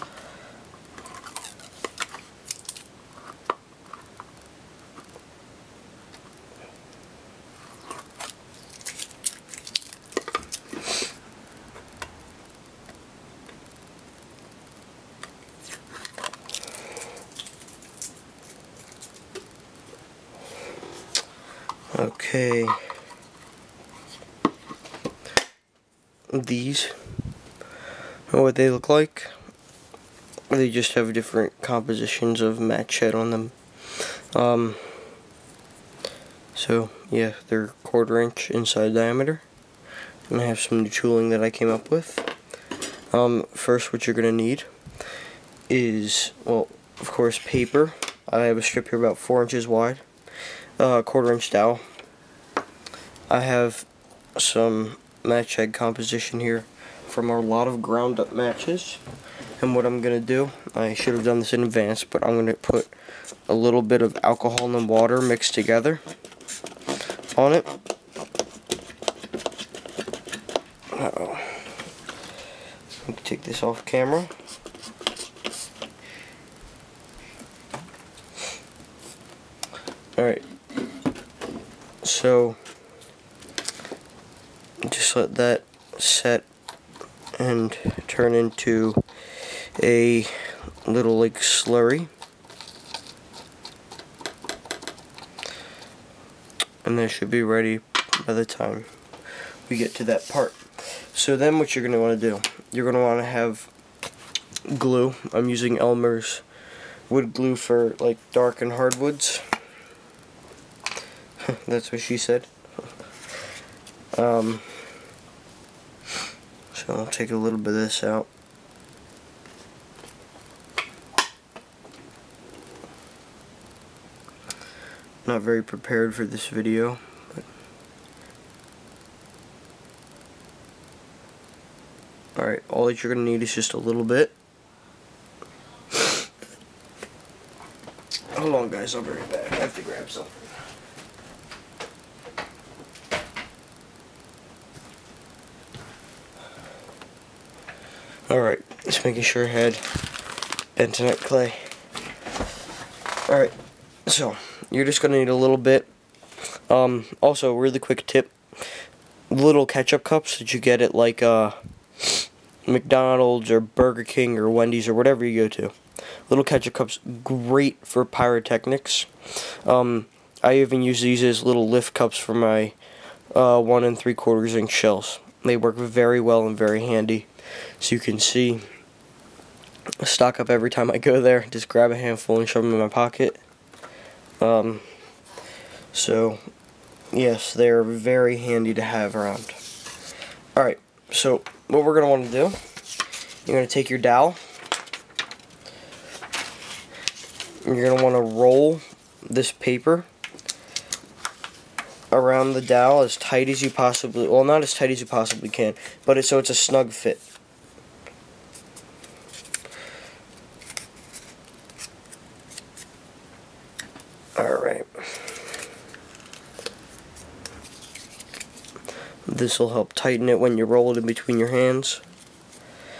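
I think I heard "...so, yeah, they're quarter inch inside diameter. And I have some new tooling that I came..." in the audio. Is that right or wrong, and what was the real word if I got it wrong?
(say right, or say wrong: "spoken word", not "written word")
right.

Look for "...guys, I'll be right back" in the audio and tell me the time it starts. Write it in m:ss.
2:18.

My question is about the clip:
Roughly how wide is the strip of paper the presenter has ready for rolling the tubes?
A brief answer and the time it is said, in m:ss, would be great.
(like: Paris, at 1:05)
4 inches, at 0:49.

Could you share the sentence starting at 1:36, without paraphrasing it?
And that should be ready by the time we get to that part.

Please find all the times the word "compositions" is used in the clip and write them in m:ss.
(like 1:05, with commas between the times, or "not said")
0:31, 0:55.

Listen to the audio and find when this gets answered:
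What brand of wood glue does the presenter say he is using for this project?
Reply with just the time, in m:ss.
1:45.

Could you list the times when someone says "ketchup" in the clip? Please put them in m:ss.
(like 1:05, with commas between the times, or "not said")
2:39, 2:46.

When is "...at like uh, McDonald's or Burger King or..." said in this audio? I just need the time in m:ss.
2:40.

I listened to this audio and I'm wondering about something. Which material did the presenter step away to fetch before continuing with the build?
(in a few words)
bentonite clay.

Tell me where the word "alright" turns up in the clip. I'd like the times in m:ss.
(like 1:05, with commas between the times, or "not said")
1:20, 2:12, 2:28, 2:33, 3:10.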